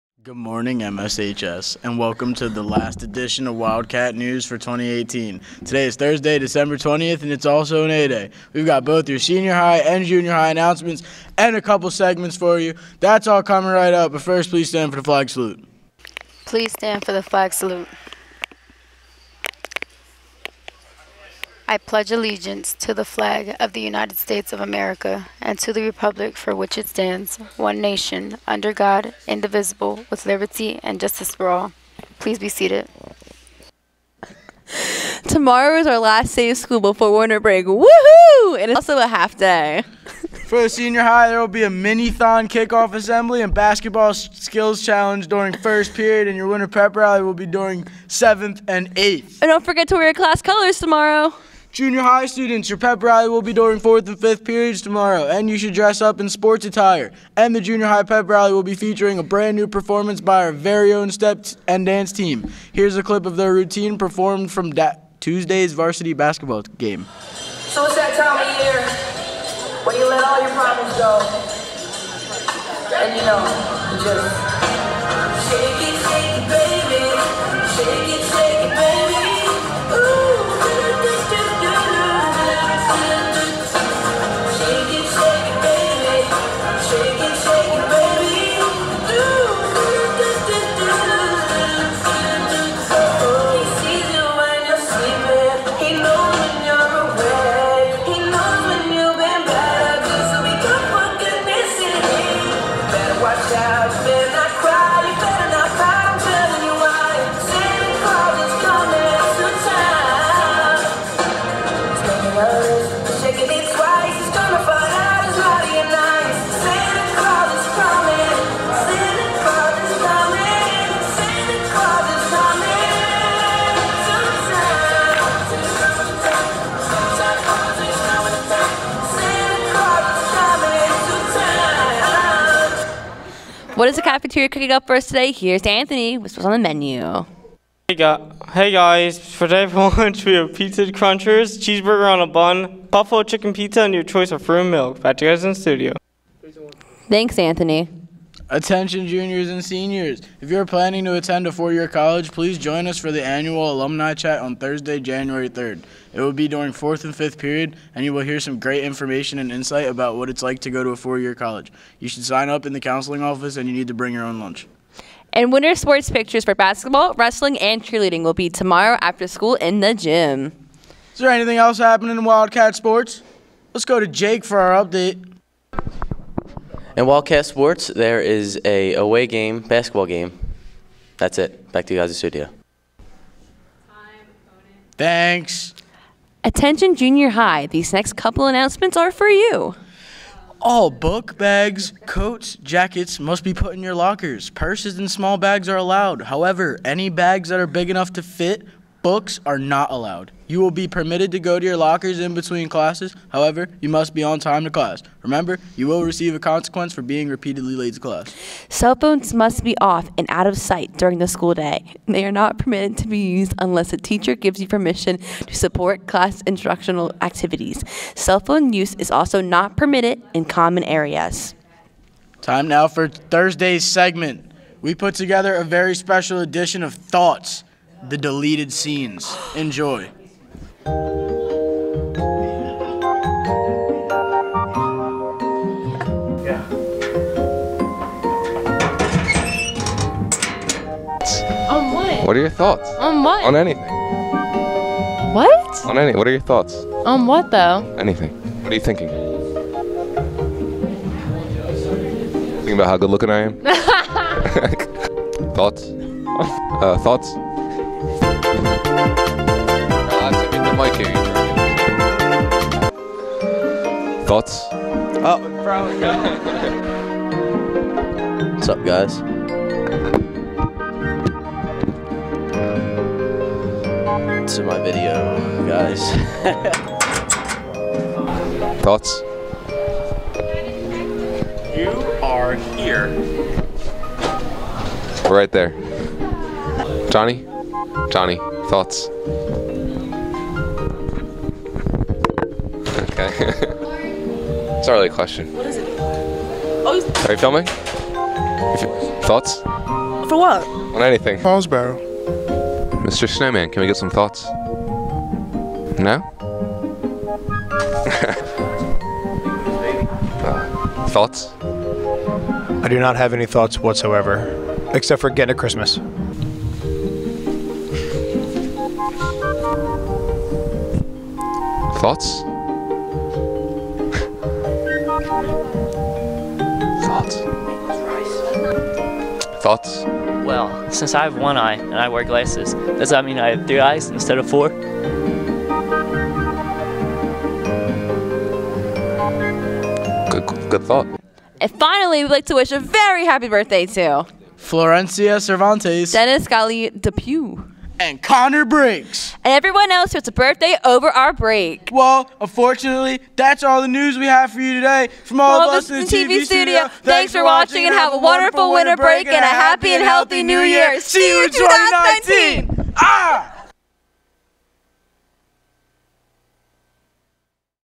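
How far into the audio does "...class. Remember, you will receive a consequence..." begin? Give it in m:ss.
3:24.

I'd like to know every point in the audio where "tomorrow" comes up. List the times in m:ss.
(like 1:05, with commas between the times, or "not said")
0:35, 0:50, 0:54, 2:48.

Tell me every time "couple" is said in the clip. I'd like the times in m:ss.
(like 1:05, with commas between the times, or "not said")
0:11, 3:08.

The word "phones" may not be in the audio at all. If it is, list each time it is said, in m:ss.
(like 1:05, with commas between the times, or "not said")
3:28, 3:38.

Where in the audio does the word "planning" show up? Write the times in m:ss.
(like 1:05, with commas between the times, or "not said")
2:30.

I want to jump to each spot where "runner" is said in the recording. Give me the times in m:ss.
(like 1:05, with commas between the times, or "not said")
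not said.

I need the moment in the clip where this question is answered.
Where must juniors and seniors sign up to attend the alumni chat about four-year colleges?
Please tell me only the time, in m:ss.
2:42.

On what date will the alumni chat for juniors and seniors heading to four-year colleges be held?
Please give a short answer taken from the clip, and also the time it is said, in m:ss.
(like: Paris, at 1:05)
January 3rd, at 2:34.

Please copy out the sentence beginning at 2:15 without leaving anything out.
Here's Anthony with what's on the menu.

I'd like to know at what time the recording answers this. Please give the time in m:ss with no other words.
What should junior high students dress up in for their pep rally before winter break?
0:56.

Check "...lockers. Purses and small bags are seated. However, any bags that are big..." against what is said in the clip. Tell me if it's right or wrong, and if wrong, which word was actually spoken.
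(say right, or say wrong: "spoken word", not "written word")
wrong: "allowed", not "seated".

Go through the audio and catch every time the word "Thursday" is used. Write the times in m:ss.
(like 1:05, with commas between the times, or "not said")
0:05, 2:34, 3:43.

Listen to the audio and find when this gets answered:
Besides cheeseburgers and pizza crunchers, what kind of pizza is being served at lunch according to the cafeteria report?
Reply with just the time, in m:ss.
2:22.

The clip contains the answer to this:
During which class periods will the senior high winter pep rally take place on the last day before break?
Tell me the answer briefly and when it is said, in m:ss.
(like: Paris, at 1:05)
7th and 8th, at 0:48.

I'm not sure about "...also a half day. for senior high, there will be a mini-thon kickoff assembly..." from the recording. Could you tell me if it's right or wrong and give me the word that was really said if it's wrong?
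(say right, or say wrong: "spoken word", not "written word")
right.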